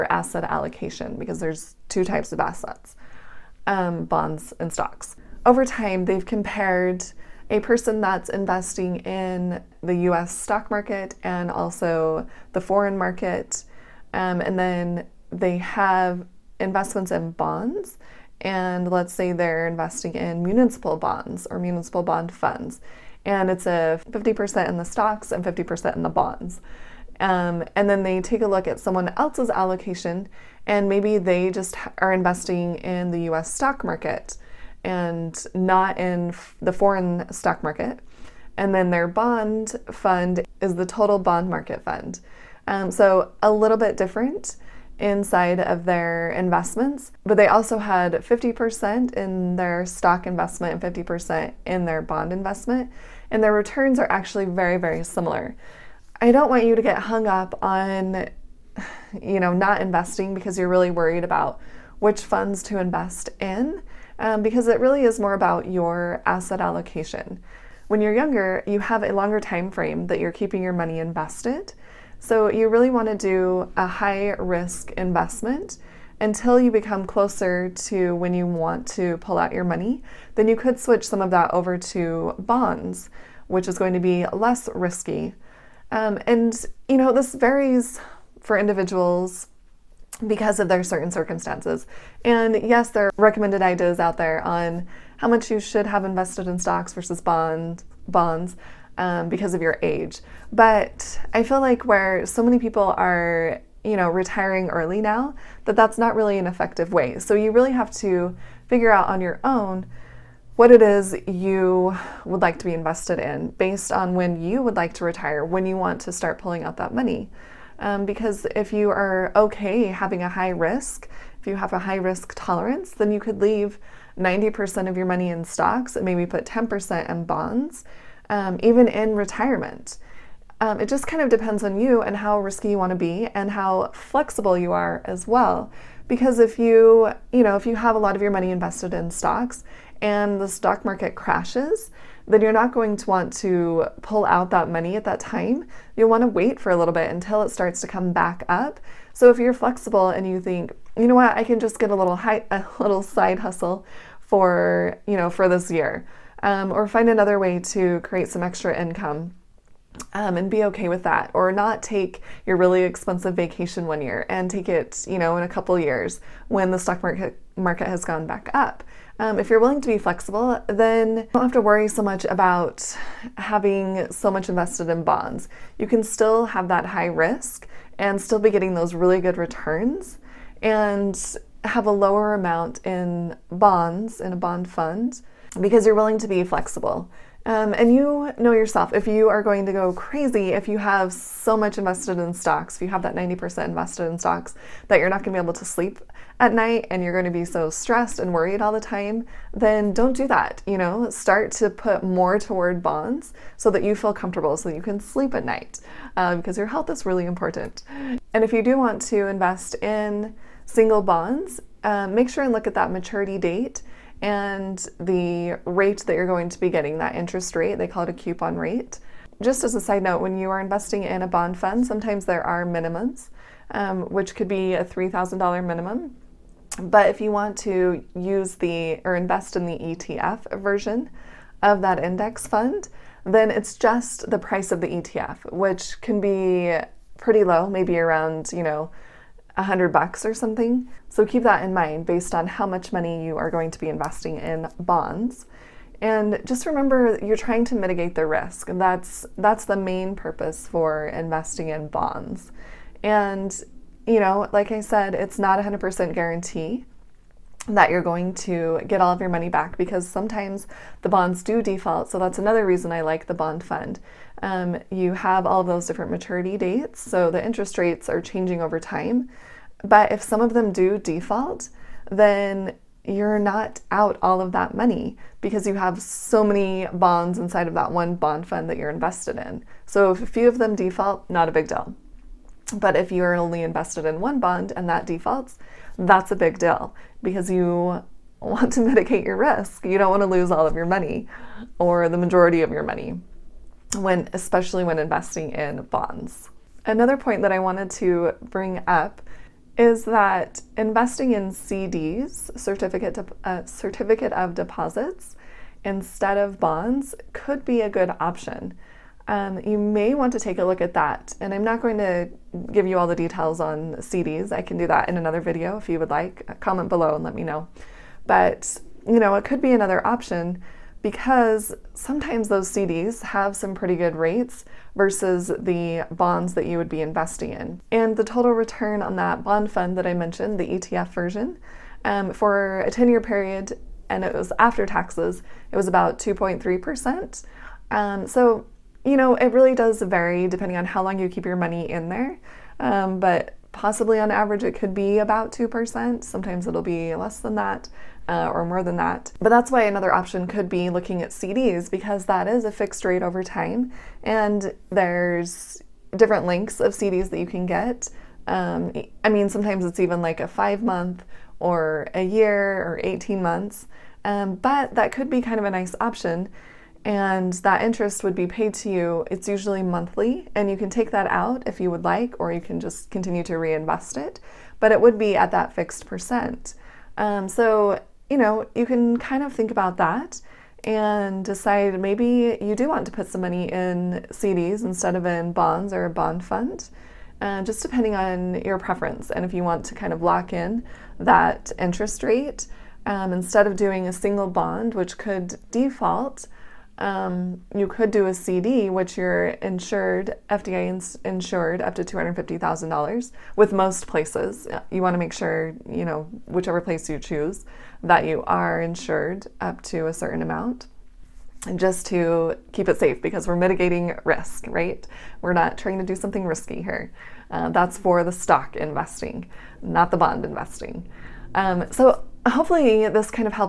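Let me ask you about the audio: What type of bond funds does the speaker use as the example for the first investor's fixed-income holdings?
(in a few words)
Municipal bond funds.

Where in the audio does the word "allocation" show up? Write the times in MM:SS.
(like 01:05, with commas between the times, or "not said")
00:00, 00:29, 01:06.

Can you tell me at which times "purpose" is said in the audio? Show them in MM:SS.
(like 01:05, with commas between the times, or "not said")
04:10.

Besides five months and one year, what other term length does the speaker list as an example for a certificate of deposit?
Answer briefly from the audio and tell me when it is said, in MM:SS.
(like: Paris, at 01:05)
18 months, at 06:03.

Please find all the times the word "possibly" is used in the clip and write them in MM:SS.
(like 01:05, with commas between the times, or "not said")
05:43.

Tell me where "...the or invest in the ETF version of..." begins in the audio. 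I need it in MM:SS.
03:48.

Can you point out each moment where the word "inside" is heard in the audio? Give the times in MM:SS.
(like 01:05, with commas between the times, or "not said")
00:45, 04:37.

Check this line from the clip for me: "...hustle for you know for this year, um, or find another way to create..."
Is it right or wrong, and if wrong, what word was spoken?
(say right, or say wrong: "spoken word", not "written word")
right.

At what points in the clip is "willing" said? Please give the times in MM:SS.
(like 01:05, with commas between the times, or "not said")
02:49, 03:05.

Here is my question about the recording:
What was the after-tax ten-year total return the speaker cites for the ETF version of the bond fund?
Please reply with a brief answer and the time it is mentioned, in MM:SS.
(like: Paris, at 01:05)
2.3%, at 05:36.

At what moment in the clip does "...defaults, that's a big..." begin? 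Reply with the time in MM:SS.
04:45.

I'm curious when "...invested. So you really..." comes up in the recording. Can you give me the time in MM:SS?
01:10.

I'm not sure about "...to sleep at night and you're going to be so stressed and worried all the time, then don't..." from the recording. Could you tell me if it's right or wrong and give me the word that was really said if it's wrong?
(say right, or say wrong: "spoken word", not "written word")
right.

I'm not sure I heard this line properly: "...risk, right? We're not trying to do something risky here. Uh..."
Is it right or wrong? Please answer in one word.
right.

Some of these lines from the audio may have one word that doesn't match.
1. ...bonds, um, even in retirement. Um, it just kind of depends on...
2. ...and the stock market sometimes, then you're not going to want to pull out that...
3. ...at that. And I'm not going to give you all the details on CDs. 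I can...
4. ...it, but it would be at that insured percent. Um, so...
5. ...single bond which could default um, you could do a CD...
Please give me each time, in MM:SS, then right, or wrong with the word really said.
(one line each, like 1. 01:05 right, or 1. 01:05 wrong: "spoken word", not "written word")
1. 02:07 right
2. 02:20 wrong: "crashes", not "sometimes"
3. 05:10 right
4. 06:14 wrong: "fixed", not "insured"
5. 06:34 right.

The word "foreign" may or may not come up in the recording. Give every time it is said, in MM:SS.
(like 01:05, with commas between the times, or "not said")
00:12, 00:36.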